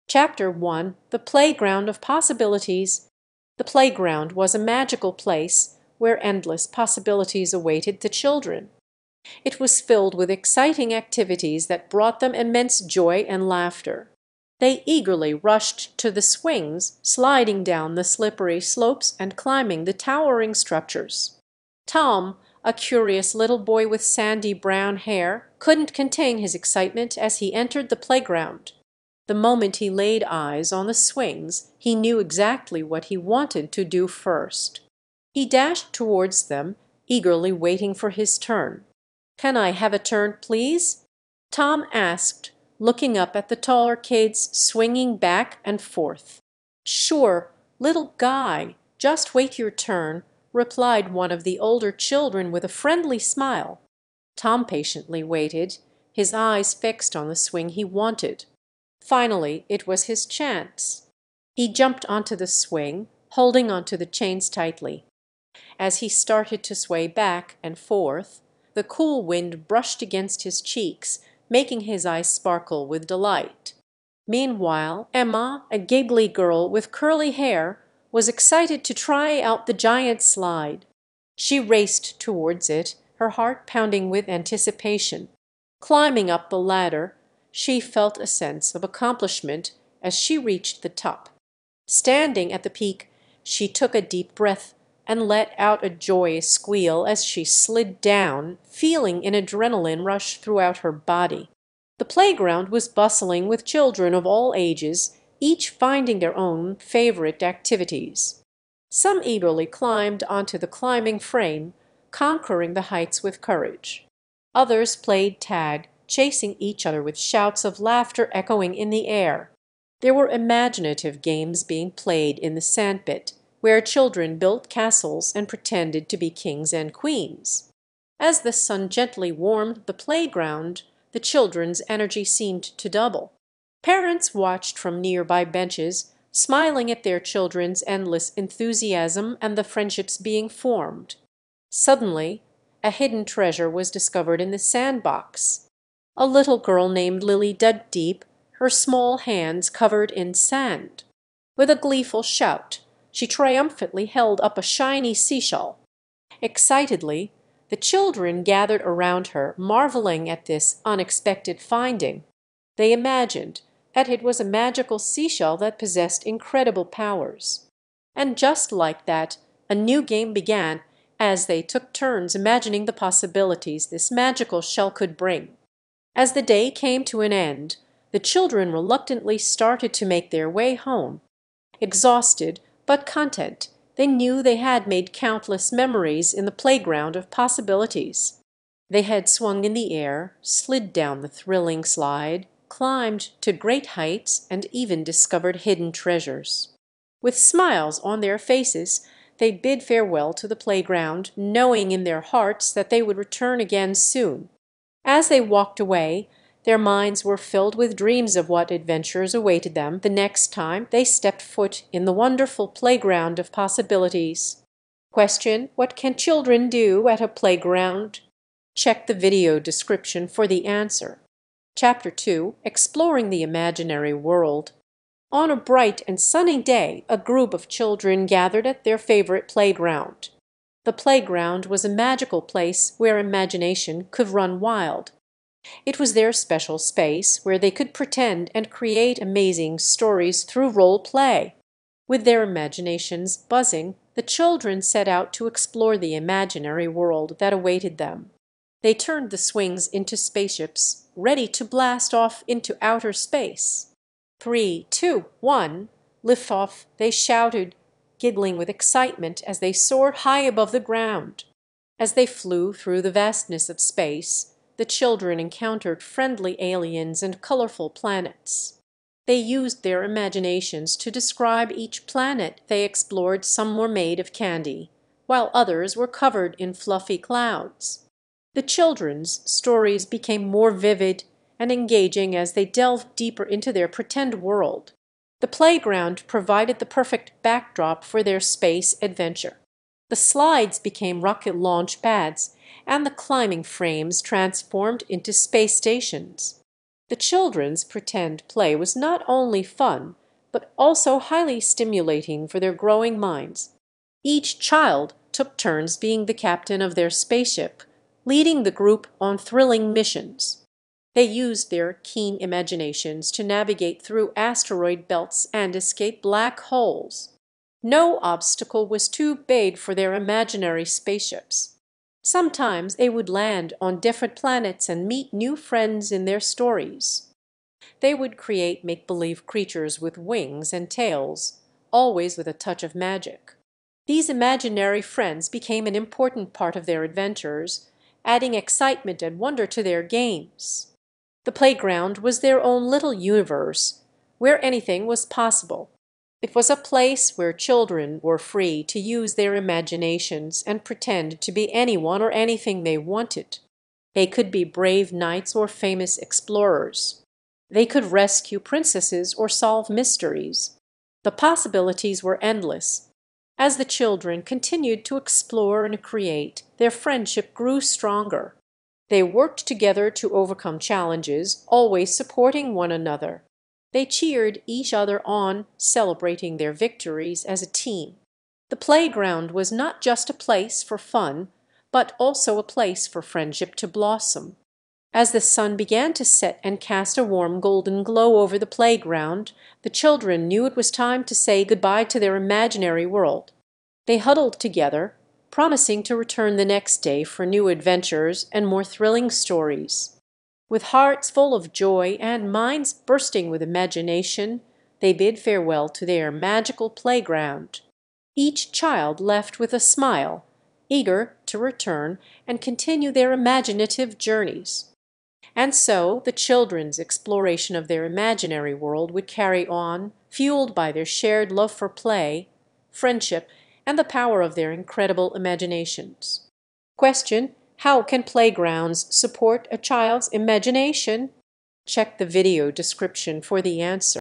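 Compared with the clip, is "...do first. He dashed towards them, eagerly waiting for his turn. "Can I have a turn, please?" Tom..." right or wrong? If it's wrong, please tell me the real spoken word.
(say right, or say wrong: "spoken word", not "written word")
right.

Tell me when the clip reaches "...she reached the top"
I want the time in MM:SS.
01:30.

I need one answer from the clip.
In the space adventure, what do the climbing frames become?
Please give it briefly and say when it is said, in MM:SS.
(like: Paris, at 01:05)
space stations, at 04:55.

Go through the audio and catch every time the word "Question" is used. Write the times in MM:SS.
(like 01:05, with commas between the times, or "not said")
03:35, 07:06.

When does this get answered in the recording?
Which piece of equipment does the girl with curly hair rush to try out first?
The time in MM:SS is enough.
01:19.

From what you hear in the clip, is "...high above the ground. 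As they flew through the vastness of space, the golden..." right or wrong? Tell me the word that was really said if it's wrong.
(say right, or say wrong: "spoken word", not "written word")
wrong: "children", not "golden".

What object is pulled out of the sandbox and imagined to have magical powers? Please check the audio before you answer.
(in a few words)
a shiny seashell.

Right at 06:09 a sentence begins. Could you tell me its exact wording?
They worked together to overcome challenges, always supporting one another.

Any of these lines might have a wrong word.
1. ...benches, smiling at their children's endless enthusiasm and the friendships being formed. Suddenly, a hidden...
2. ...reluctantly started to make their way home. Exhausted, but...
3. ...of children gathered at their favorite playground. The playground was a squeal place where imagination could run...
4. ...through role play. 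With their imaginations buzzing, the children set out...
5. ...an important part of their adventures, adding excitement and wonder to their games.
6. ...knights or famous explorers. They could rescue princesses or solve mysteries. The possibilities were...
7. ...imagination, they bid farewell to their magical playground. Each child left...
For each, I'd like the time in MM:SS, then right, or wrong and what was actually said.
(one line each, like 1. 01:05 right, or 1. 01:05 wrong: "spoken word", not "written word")
1. 02:15 right
2. 02:58 right
3. 03:47 wrong: "magical", not "squeal"
4. 04:00 right
5. 05:35 right
6. 05:55 right
7. 06:43 right.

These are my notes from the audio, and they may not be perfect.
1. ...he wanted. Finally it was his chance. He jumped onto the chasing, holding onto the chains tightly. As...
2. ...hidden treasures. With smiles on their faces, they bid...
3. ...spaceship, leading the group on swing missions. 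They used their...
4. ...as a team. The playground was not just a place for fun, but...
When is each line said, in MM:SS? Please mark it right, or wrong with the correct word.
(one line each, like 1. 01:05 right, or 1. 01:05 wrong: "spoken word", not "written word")
1. 00:57 wrong: "swing", not "chasing"
2. 03:15 right
3. 05:07 wrong: "thrilling", not "swing"
4. 06:17 right.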